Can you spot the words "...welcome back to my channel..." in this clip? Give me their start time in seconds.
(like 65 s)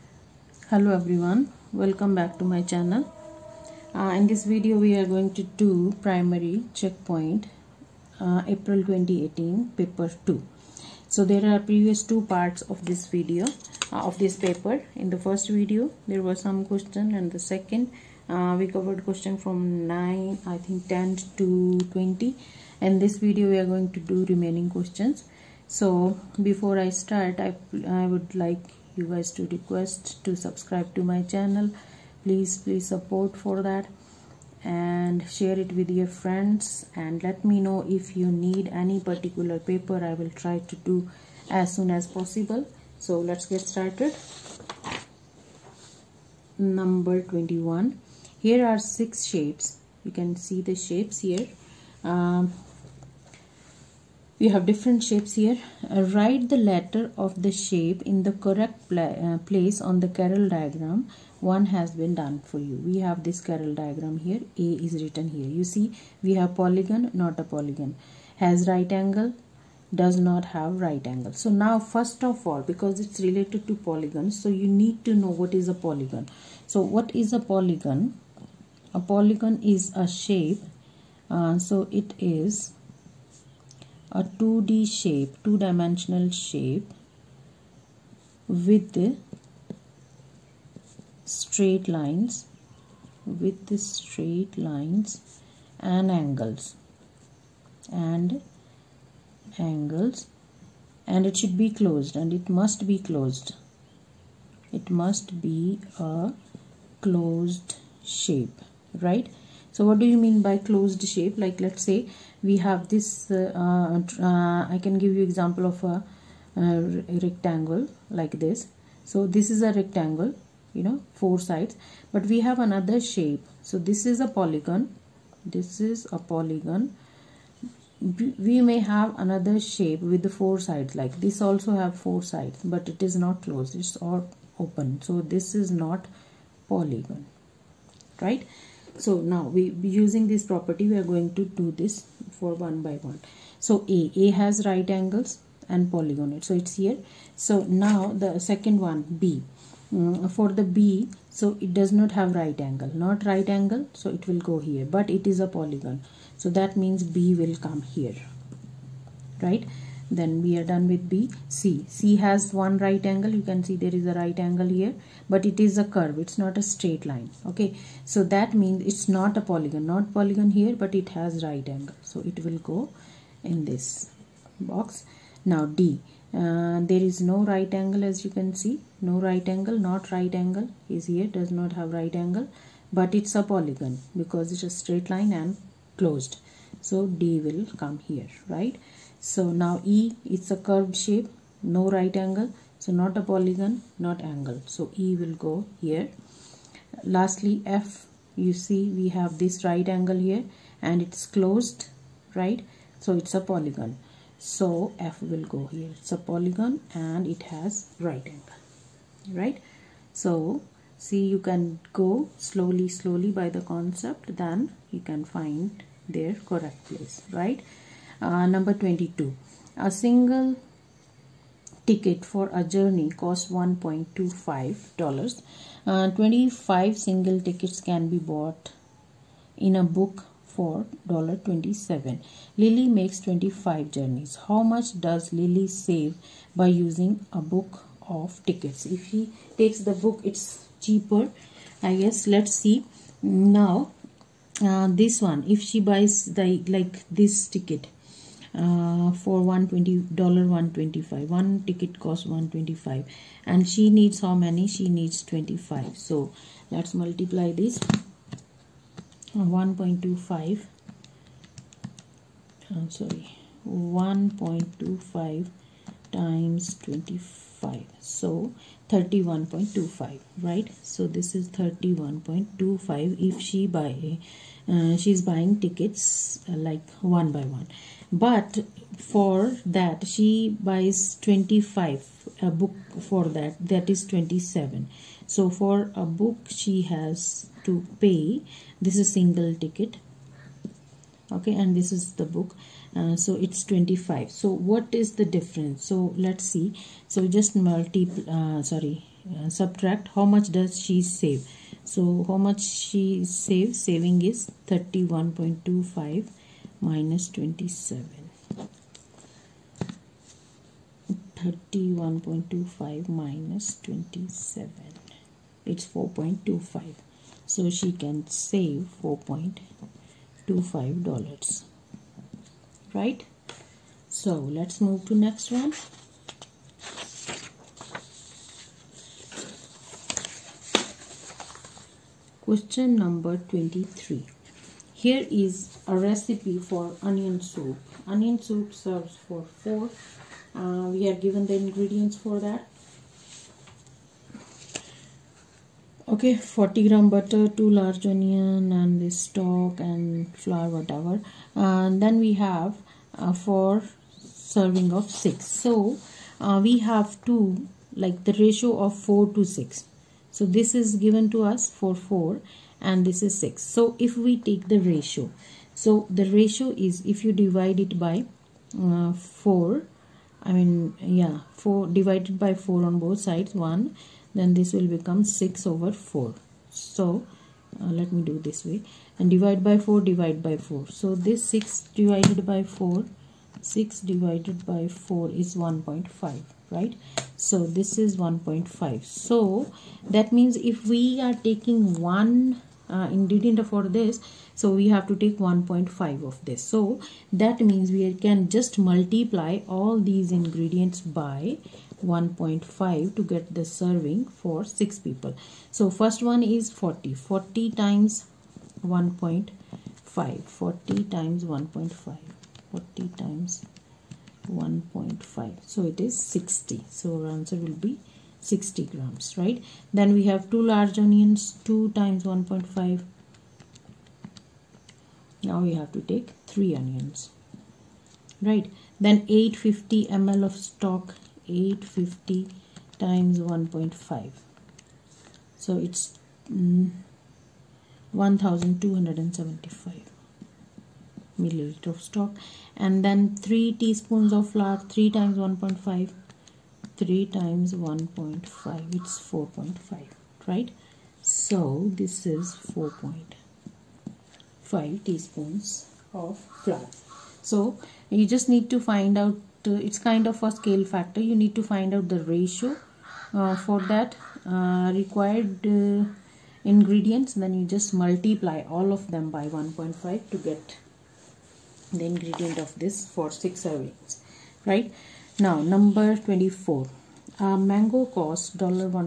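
1 s.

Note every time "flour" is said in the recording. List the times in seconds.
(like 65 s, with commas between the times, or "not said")
350 s, 444 s, 456 s.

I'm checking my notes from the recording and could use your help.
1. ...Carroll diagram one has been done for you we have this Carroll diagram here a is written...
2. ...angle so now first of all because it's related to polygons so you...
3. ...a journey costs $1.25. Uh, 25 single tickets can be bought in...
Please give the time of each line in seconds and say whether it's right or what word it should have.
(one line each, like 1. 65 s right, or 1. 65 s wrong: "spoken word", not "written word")
1. 60 s right
2. 71 s right
3. 222 s right.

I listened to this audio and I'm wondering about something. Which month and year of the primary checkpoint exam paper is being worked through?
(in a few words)
April 2018.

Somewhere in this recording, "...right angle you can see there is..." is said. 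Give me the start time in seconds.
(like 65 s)
162 s.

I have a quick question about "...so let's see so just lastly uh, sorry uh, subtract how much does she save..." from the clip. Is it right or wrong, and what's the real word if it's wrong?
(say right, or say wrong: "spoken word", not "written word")
wrong: "multiply", not "lastly".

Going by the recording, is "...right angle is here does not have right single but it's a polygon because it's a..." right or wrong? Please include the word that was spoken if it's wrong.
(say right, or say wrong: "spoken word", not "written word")
wrong: "angle", not "single".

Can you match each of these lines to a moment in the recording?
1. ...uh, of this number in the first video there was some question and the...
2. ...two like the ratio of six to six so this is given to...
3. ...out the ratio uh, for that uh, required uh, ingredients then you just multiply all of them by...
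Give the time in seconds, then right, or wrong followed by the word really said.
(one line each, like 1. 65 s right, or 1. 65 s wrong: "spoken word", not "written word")
1. 13 s wrong: "paper", not "number"
2. 357 s wrong: "four", not "six"
3. 461 s right.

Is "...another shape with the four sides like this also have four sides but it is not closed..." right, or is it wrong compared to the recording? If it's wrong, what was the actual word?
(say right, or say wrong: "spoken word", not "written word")
right.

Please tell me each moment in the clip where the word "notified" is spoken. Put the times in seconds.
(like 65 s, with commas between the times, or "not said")
not said.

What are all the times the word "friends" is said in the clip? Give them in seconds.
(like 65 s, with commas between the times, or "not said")
36 s.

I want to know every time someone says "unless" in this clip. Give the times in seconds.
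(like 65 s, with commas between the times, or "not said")
not said.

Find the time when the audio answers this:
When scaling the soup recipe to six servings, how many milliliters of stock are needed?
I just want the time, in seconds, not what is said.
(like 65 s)
438 s.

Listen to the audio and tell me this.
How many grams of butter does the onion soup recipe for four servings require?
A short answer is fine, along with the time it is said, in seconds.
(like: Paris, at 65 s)
40 grams, at 346 s.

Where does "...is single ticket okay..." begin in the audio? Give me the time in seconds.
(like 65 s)
289 s.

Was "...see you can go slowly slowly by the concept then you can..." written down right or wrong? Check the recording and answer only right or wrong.
right.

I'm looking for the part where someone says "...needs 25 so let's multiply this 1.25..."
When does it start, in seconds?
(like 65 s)
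254 s.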